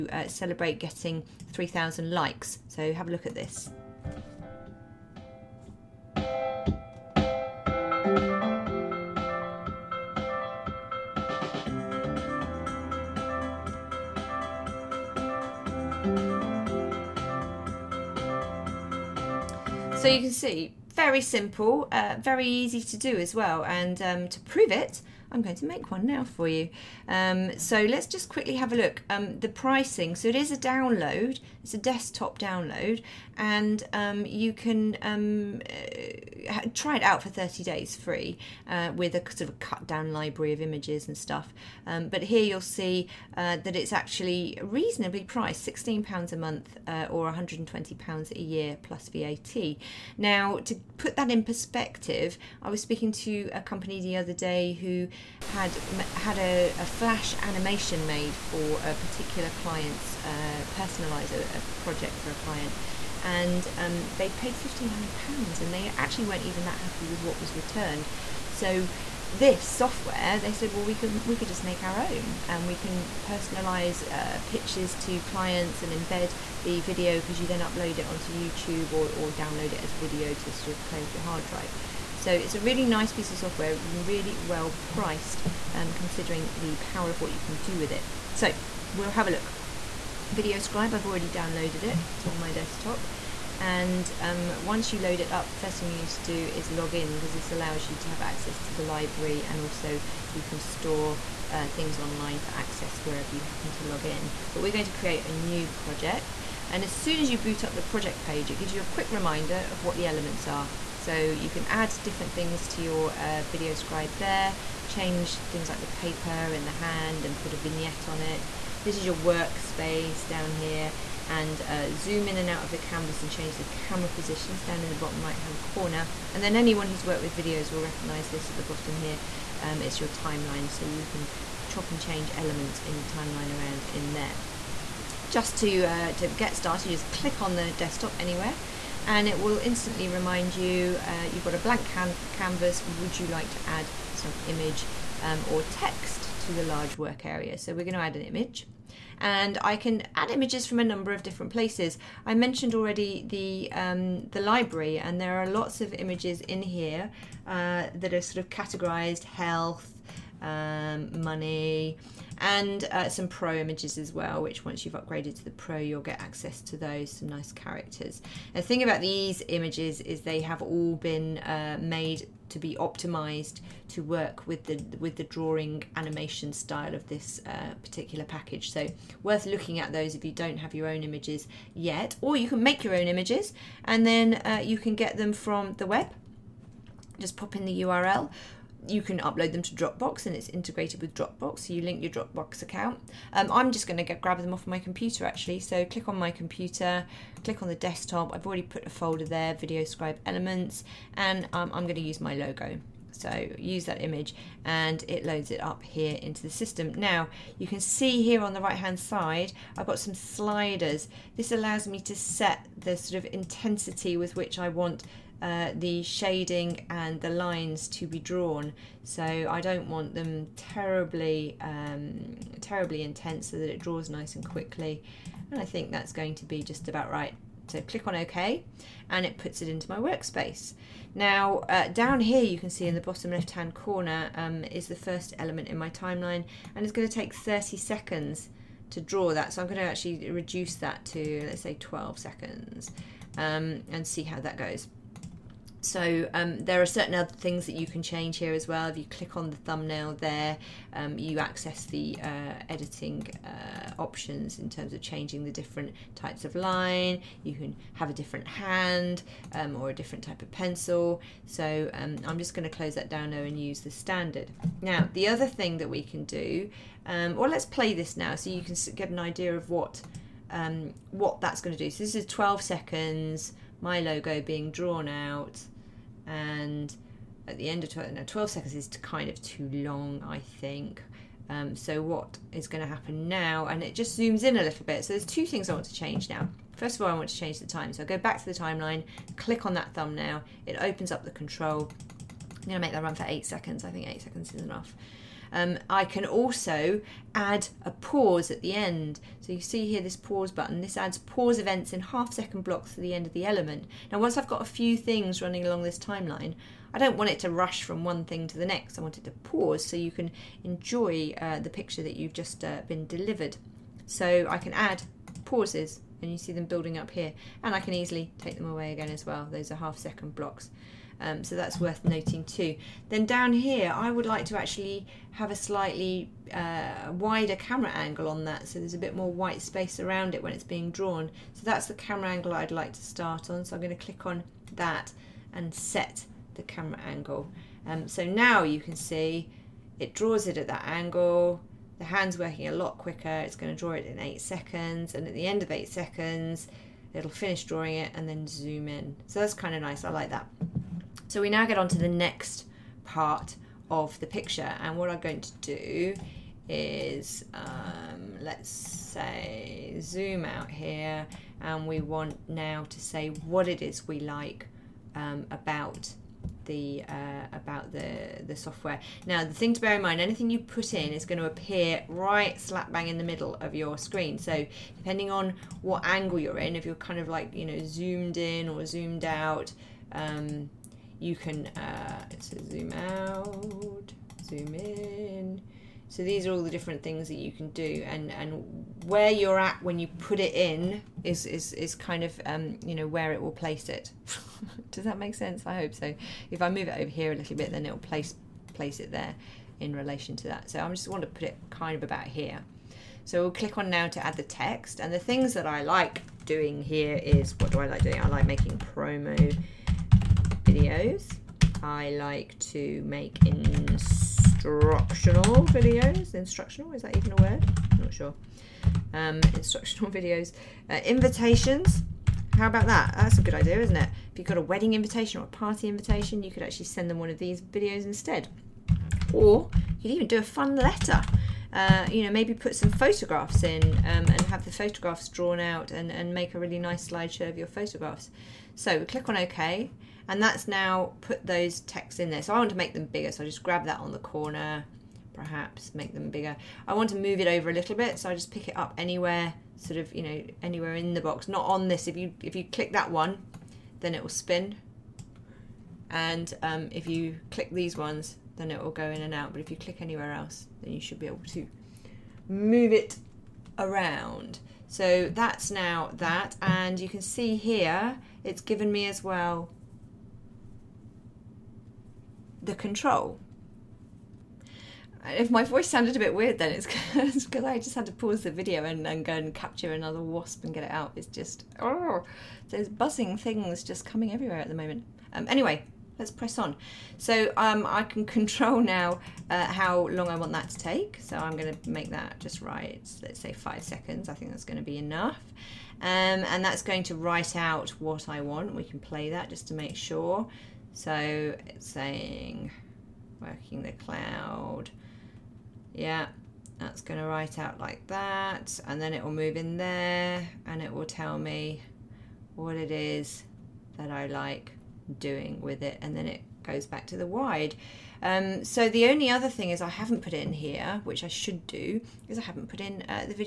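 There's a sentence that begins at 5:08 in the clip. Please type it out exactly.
I want it to pause so you can enjoy uh, the picture that you've just uh, been delivered.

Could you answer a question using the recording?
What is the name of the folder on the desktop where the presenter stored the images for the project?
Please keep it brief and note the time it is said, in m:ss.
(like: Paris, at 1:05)
Video Elements, at 3:19.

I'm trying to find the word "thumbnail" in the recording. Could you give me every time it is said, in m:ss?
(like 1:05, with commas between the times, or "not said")
4:09, 4:49.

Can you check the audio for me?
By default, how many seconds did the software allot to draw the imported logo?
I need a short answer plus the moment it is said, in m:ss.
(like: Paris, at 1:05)
30 seconds, at 3:57.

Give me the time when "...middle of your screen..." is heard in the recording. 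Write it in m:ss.
6:13.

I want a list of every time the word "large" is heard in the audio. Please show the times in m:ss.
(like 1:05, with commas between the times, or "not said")
2:26.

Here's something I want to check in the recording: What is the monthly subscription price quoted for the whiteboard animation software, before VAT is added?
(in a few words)
£16.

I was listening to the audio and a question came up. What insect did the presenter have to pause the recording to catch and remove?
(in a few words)
wasp.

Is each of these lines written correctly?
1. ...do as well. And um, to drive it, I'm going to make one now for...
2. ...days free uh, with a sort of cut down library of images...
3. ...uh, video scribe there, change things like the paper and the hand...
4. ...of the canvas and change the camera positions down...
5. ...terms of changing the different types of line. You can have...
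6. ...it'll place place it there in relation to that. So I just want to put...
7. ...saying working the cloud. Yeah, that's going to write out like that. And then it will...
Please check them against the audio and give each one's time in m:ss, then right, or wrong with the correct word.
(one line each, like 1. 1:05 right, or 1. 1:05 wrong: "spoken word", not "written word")
1. 0:22 wrong: "prove", not "drive"
2. 0:37 right
3. 1:53 right
4. 2:02 right
5. 4:14 right
6. 6:37 right
7. 8:21 right.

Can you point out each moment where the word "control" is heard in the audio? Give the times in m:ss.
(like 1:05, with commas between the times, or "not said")
4:51, 7:52, 8:08.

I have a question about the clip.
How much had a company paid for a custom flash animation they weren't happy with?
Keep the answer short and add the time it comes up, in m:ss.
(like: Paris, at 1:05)
£1,500, at 1:04.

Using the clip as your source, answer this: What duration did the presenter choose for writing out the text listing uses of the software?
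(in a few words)
5 seconds.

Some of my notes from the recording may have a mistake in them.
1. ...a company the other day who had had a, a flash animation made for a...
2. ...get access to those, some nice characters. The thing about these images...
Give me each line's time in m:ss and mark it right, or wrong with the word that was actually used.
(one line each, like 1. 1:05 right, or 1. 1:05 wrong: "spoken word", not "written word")
1. 0:53 right
2. 2:46 right.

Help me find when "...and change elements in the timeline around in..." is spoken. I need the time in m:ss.
2:11.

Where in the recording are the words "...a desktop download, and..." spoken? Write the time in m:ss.
0:31.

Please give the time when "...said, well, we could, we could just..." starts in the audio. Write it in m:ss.
1:10.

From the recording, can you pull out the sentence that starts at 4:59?
So you see here this pause button.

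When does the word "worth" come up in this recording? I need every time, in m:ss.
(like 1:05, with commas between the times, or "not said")
2:59, 5:21.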